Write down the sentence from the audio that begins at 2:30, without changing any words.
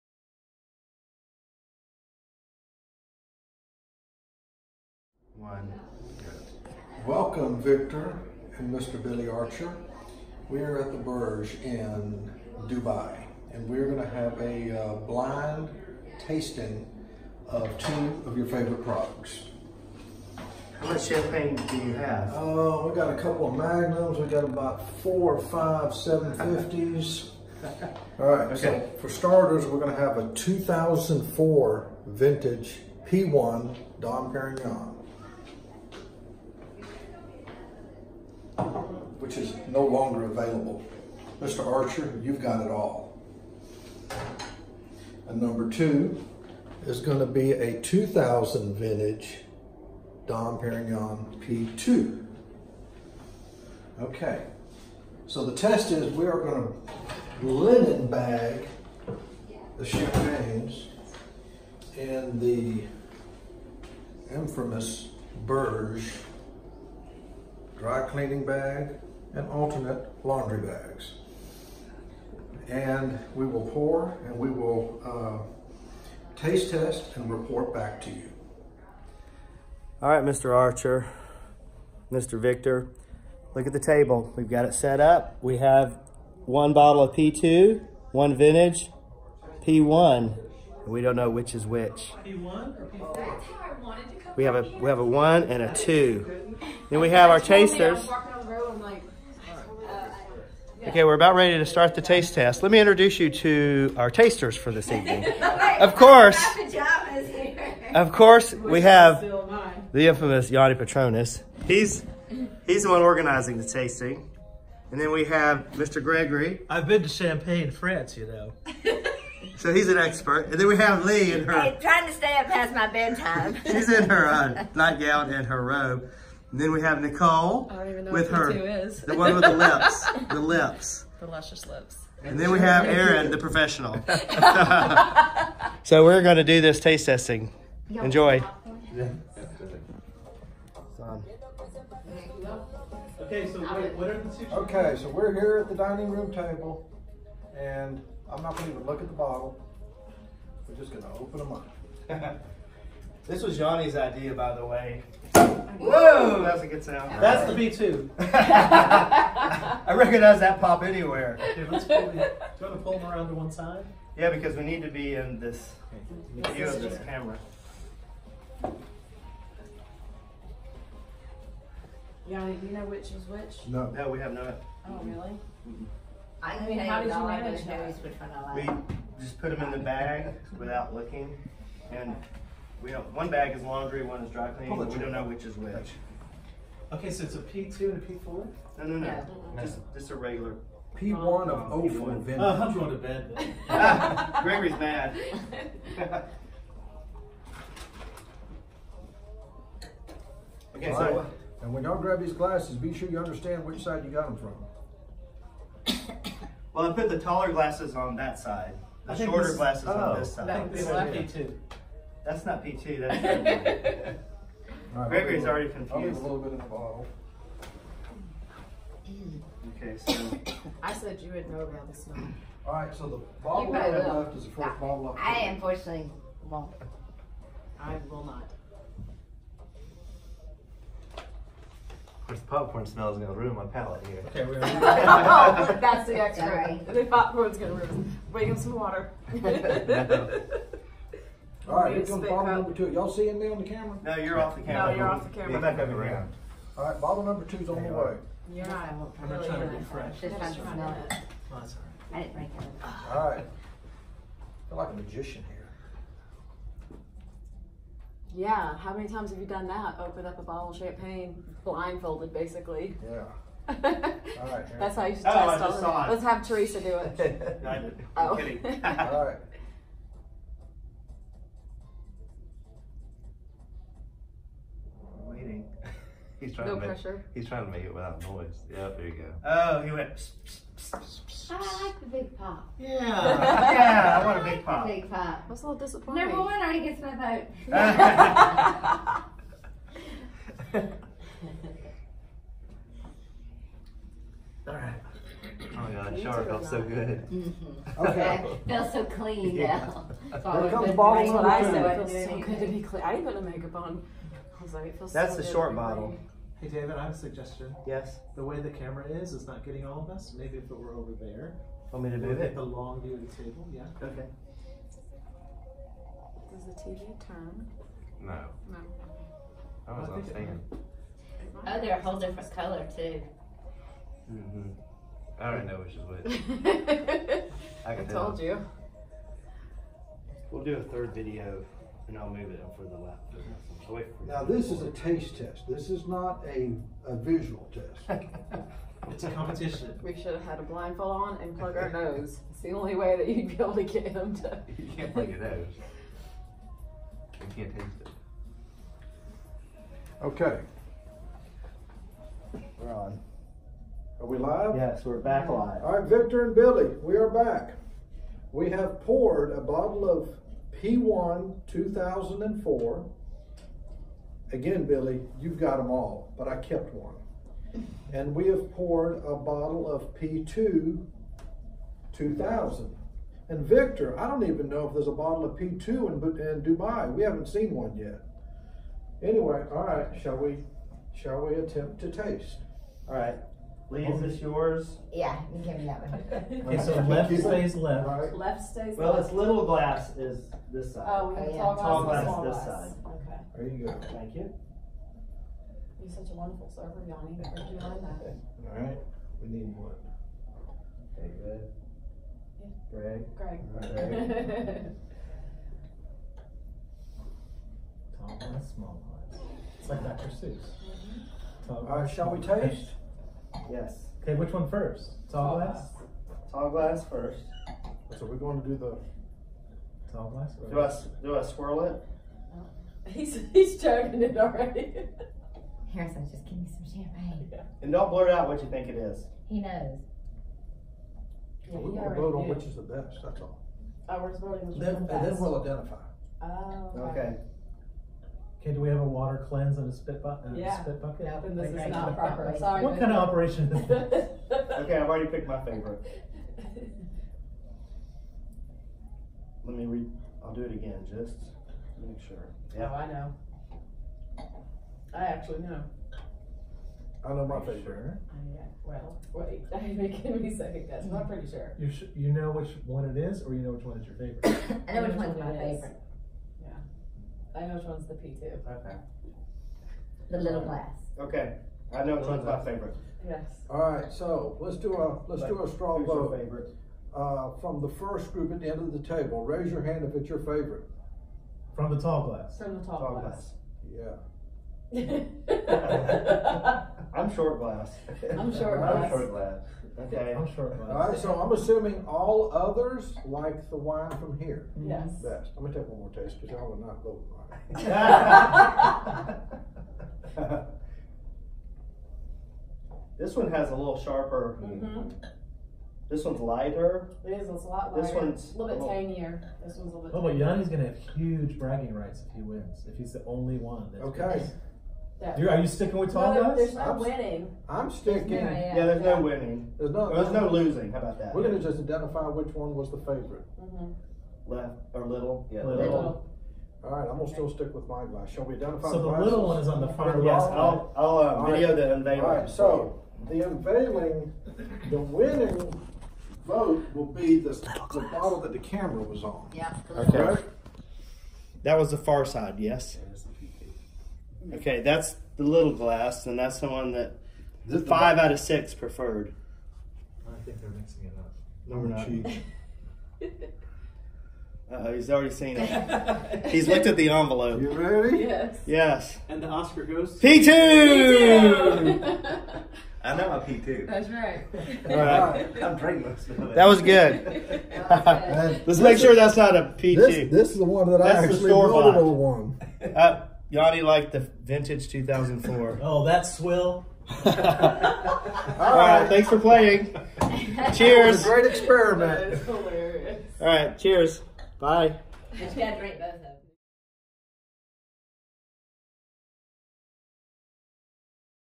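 We're just going to open them up.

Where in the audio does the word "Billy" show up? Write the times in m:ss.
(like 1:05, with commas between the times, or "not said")
0:09, 5:56, 6:04.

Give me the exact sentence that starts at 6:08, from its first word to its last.
And we have poured a bottle of P2 2000.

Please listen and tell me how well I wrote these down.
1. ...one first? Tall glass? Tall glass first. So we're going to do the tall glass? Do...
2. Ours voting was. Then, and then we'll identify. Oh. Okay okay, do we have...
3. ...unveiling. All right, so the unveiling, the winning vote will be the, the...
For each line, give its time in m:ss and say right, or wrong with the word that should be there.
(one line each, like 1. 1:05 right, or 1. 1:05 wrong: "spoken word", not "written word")
1. 6:54 right
2. 7:14 right
3. 8:51 right.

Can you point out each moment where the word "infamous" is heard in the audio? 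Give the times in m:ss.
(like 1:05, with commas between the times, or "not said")
1:04, 1:50.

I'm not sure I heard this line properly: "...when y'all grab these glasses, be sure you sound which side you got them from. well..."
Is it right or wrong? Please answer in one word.
wrong.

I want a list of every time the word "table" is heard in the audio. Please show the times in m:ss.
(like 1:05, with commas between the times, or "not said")
1:23, 2:26, 5:13, 7:59.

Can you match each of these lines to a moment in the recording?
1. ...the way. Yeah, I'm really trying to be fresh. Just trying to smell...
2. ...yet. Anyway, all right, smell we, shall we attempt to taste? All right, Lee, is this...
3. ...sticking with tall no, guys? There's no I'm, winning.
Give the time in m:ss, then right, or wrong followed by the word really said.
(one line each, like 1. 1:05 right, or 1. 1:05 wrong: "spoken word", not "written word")
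1. 4:07 right
2. 6:17 wrong: "shall", not "smell"
3. 8:35 right.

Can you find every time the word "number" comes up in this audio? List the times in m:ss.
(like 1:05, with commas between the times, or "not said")
0:45, 4:02, 4:07, 4:46, 5:01.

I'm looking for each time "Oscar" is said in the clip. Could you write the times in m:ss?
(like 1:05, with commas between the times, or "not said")
9:19.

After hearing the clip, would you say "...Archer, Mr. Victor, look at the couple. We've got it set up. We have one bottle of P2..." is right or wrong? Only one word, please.
wrong.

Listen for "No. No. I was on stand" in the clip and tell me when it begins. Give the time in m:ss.
5:18.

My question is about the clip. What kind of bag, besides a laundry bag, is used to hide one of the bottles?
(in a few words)
Dry cleaning bag.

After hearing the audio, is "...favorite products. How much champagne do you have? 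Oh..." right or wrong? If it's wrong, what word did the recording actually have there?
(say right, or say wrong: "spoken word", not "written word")
right.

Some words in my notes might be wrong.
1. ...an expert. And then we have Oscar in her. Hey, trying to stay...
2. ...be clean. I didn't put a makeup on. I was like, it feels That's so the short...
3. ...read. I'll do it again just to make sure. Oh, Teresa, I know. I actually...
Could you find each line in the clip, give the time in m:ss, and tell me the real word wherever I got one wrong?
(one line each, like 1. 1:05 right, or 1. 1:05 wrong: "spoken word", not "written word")
1. 1:59 wrong: "Lee", not "Oscar"
2. 5:02 right
3. 7:29 wrong: "Yeah", not "Teresa".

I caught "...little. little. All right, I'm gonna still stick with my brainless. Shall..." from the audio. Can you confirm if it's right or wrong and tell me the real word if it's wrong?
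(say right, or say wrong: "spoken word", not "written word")
wrong: "glass", not "brainless".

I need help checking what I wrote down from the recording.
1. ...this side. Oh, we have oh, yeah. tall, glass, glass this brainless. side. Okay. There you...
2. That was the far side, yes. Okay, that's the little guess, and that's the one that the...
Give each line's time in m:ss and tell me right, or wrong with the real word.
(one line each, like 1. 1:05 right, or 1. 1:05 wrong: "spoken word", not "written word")
1. 6:30 wrong: "glass", not "brainless"
2. 9:01 wrong: "glass", not "guess".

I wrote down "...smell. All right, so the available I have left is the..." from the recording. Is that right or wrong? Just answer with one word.
wrong.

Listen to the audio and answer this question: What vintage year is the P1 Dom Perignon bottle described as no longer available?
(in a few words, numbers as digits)
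2004.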